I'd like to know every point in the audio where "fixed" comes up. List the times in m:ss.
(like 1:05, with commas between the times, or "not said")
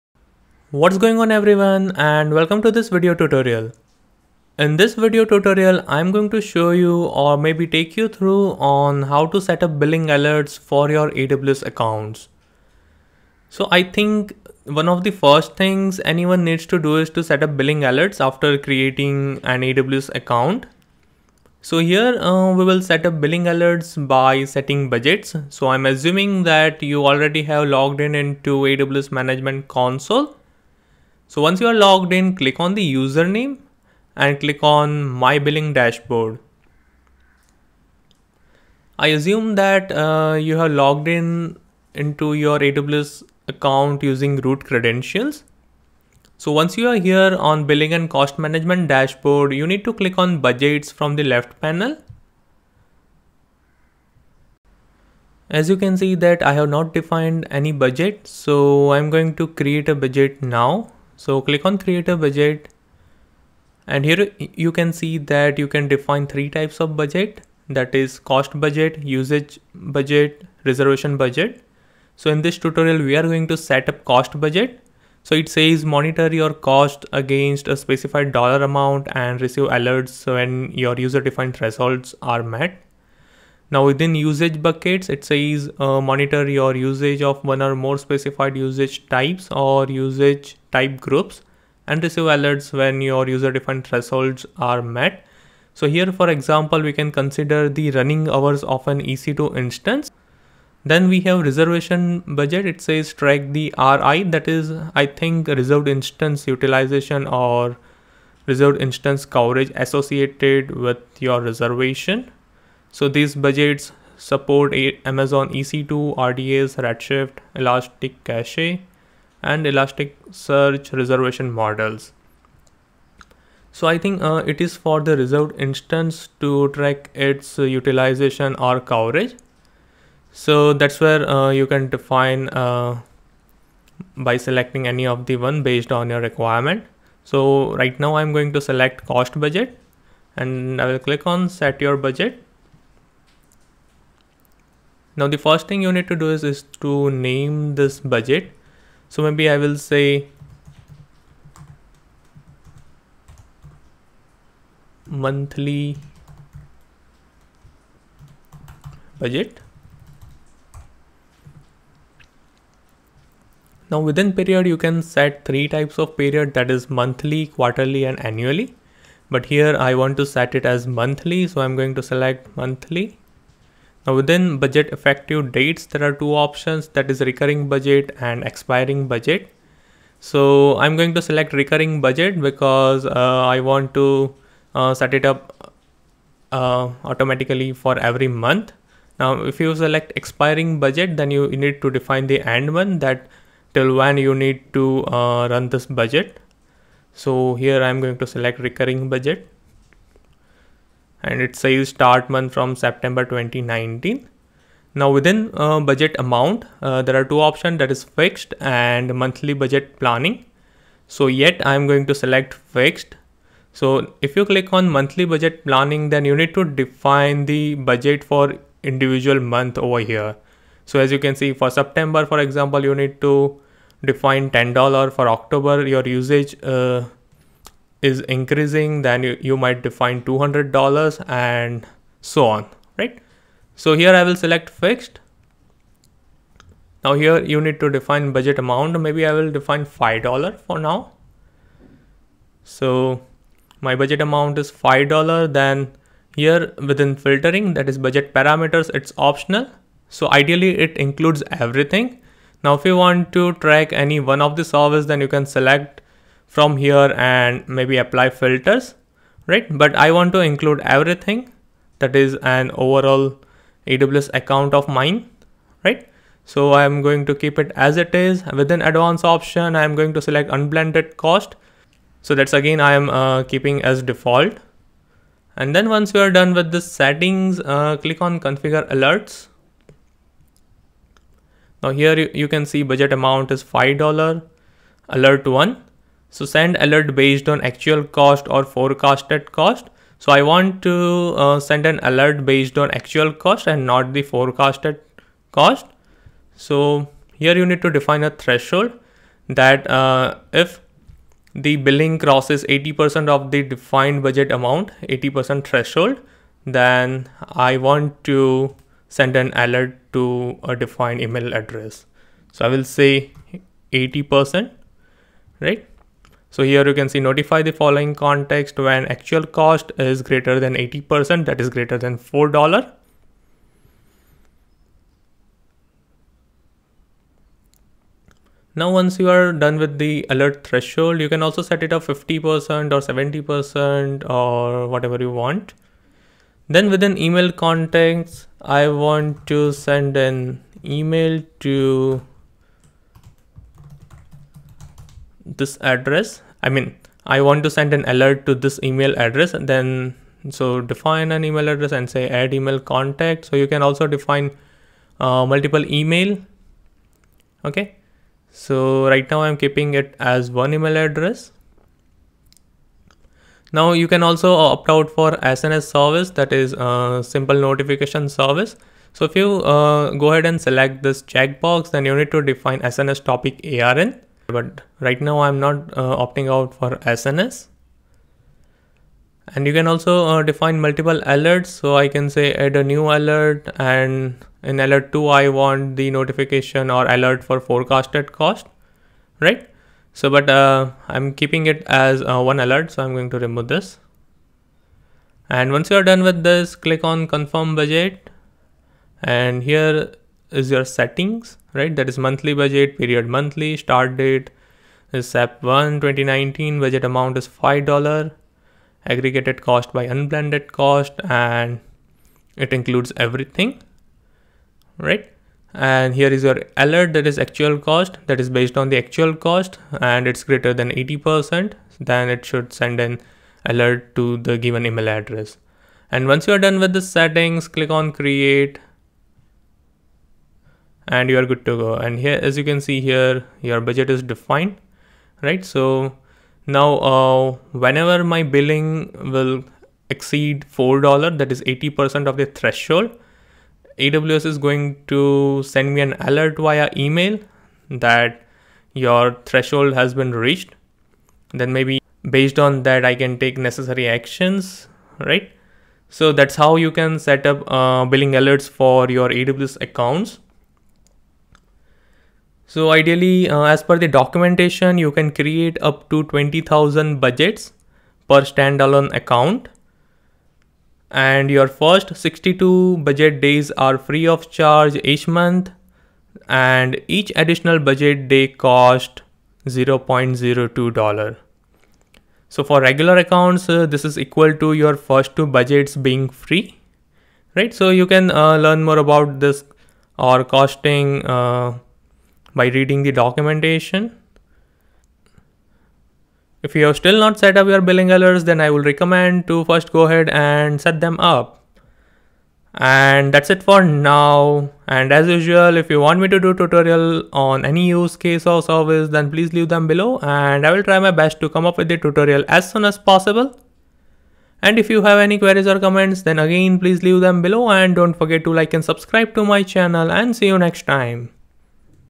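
3:28, 3:32, 3:54.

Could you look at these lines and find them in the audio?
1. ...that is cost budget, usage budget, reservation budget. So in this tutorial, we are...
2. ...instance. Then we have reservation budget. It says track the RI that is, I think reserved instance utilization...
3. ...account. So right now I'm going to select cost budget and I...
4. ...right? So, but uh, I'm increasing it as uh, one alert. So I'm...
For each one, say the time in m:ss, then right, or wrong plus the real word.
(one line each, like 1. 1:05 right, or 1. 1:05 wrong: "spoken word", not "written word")
1. 1:07 right
2. 1:39 right
3. 2:16 wrong: "requirement", not "account"
4. 6:29 wrong: "keeping", not "increasing".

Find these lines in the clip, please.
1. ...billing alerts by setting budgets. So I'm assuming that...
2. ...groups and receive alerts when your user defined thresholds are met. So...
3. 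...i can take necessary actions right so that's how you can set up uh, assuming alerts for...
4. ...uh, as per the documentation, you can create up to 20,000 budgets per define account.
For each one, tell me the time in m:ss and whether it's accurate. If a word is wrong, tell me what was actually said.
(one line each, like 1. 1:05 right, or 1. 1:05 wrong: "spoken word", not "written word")
1. 0:23 right
2. 1:30 right
3. 7:33 wrong: "billing", not "assuming"
4. 7:43 wrong: "standalone", not "define".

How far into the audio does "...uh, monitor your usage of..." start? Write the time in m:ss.
1:25.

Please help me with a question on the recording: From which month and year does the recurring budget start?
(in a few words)
September 2019.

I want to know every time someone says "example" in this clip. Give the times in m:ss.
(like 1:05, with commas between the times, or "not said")
1:36, 3:42.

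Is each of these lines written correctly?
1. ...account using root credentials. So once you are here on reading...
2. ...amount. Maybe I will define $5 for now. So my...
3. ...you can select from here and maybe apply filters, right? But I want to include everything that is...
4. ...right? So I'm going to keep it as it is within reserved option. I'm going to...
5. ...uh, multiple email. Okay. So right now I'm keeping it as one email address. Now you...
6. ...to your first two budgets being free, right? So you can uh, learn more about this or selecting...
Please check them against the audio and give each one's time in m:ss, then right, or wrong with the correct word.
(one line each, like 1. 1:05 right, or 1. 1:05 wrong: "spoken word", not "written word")
1. 0:43 wrong: "billing", not "reading"
2. 3:58 right
3. 4:15 right
4. 4:25 wrong: "advanced", not "reserved"
5. 5:55 right
6. 8:04 wrong: "costing", not "selecting".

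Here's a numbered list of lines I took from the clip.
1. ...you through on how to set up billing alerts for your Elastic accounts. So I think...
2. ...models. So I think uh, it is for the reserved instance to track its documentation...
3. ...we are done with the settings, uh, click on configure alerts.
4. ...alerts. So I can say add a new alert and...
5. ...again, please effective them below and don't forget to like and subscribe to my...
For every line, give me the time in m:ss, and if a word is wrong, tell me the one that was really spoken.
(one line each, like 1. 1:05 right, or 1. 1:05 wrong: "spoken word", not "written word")
1. 0:07 wrong: "AWS", not "Elastic"
2. 2:01 wrong: "utilization", not "documentation"
3. 4:36 right
4. 6:21 right
5. 8:36 wrong: "leave", not "effective".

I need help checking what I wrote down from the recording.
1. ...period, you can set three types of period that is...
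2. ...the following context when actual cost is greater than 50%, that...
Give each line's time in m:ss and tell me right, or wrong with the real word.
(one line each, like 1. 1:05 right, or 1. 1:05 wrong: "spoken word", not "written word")
1. 2:44 right
2. 5:17 wrong: "80", not "50".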